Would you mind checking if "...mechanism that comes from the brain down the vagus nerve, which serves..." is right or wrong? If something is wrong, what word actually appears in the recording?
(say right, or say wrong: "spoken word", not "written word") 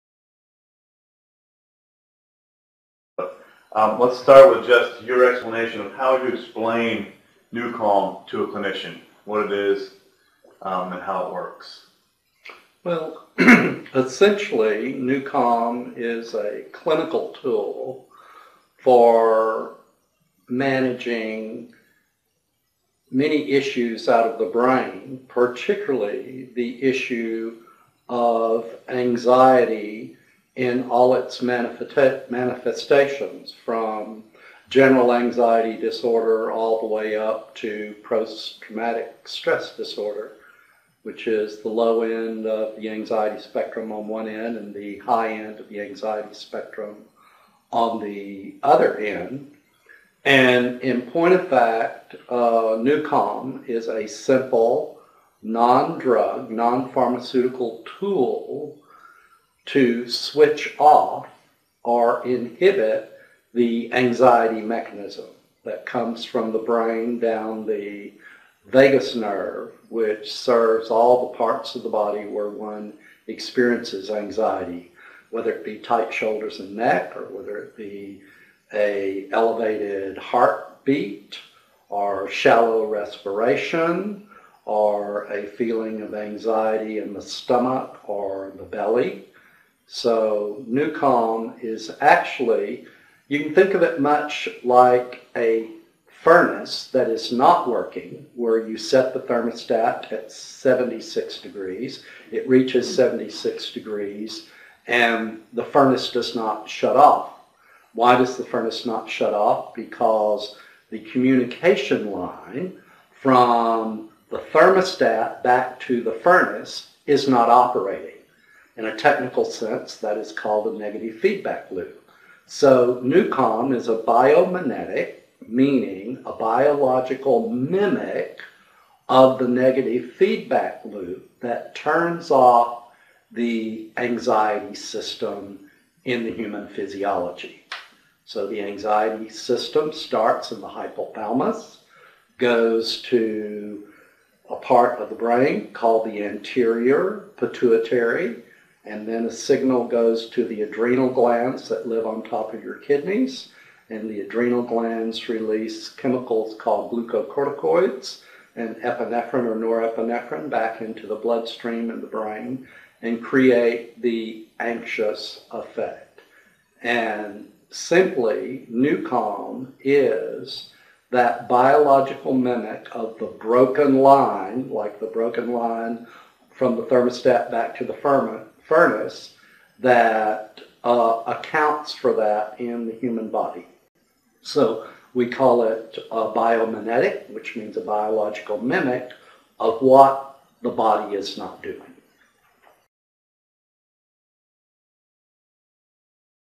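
right.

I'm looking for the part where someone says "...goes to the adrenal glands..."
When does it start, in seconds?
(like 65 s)
149 s.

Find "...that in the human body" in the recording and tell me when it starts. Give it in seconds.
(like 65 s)
182 s.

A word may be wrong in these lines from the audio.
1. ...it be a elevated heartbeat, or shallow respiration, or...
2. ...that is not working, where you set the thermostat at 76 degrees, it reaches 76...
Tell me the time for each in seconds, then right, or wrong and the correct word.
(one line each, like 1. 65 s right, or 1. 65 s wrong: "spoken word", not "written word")
1. 77 s right
2. 96 s right.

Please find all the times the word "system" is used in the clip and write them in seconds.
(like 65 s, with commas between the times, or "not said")
134 s, 139 s.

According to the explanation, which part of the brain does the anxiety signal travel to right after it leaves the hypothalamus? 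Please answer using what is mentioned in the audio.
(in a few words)
anterior pituitary.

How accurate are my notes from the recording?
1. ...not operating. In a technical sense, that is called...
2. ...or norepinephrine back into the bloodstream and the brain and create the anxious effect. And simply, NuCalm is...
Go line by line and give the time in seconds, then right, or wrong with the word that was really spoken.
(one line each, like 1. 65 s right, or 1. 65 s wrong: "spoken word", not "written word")
1. 117 s right
2. 159 s right.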